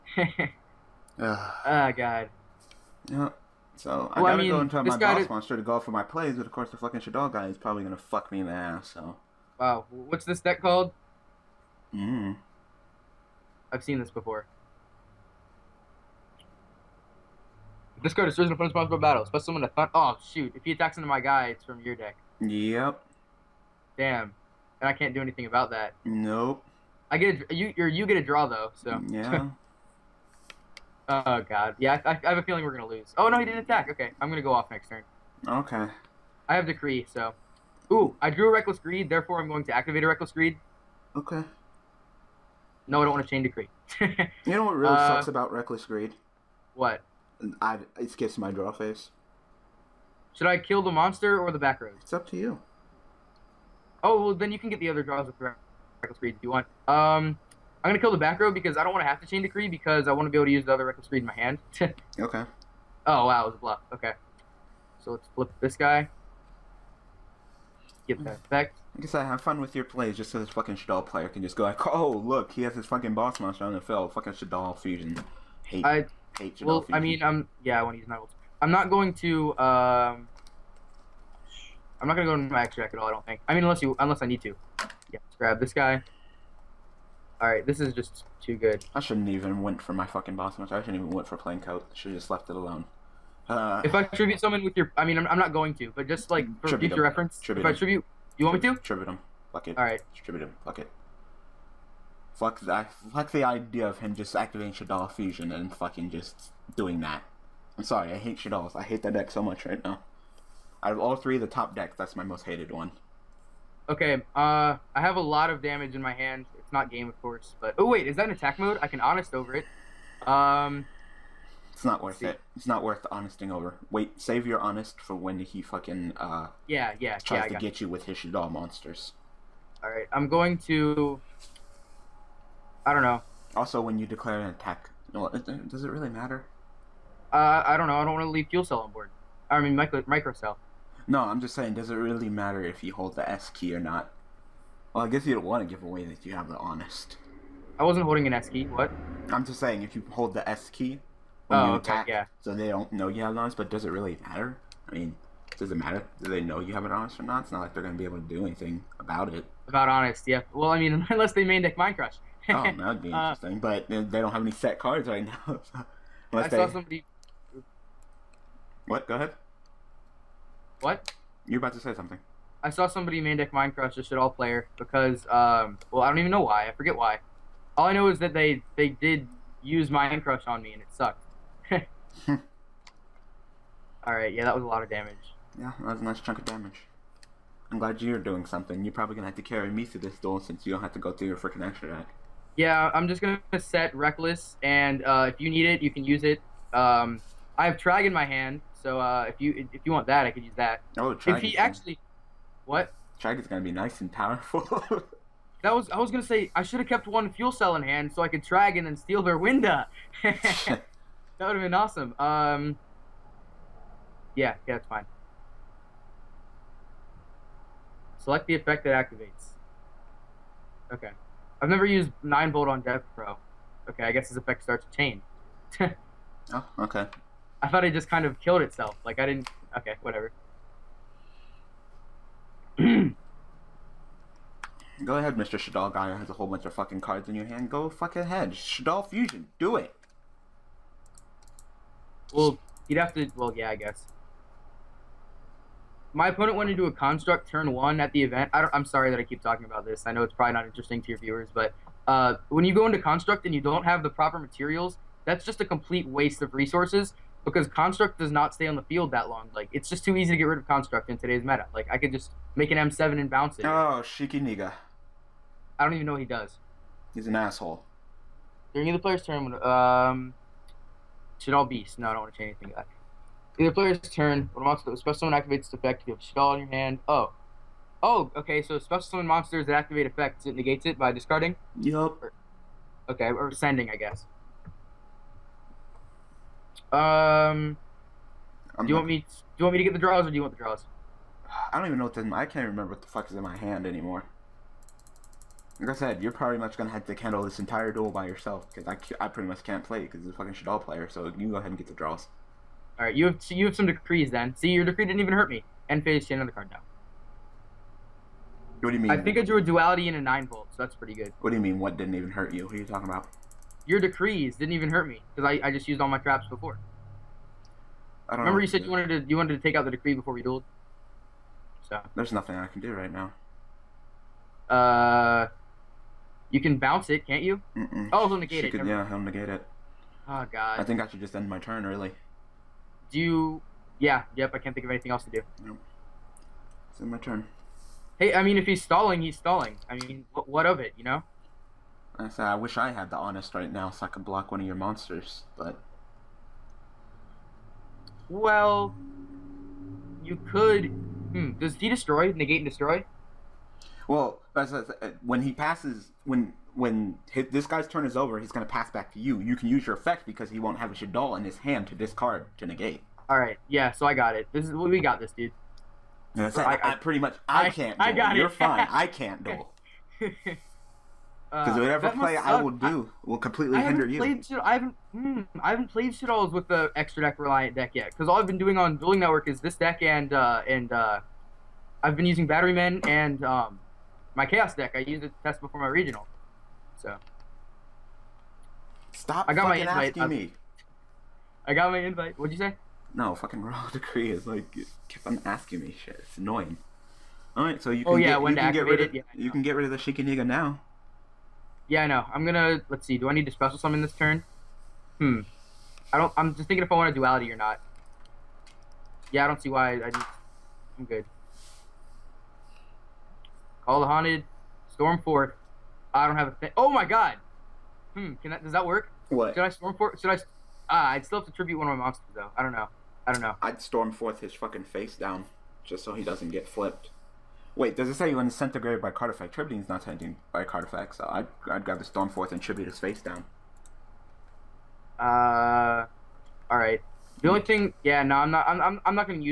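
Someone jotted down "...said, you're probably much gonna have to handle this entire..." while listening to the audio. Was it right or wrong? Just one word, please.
right.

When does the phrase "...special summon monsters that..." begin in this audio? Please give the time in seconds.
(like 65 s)
278 s.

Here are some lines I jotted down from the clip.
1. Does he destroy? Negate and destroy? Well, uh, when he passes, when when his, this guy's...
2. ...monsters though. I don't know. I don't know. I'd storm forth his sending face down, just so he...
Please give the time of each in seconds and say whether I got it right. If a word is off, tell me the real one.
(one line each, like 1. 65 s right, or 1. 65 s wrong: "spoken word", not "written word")
1. 351 s right
2. 422 s wrong: "fucking", not "sending".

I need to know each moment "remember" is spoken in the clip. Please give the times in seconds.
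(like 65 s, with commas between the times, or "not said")
292 s, 318 s.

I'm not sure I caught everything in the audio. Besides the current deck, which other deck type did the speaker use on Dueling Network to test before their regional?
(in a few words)
Chaos.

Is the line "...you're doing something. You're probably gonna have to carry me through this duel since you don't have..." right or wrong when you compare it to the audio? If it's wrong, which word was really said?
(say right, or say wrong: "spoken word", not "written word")
right.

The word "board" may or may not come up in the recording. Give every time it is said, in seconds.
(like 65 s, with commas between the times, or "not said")
138 s.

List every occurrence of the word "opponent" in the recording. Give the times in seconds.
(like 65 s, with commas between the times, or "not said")
18 s, 246 s.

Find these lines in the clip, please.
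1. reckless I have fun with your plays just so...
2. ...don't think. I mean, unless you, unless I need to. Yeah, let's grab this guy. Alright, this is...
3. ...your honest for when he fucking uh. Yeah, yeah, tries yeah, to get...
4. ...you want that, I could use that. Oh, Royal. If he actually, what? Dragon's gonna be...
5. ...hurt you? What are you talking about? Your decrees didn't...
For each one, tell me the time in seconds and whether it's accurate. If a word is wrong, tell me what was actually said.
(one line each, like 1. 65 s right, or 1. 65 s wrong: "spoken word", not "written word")
1. 68 s wrong: "guess", not "reckless"
2. 83 s right
3. 124 s right
4. 199 s wrong: "Trag", not "Royal"
5. 312 s right.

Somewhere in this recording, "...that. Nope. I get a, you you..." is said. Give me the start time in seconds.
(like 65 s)
25 s.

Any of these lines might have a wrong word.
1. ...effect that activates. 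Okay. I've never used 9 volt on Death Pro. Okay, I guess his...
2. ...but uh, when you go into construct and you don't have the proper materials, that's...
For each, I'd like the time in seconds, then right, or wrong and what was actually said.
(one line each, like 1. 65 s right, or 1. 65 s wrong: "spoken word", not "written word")
1. 218 s right
2. 251 s right.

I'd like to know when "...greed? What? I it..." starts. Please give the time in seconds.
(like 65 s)
45 s.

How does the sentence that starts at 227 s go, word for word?
I thought it just kind of killed itself.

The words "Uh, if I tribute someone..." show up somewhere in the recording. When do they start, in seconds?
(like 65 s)
93 s.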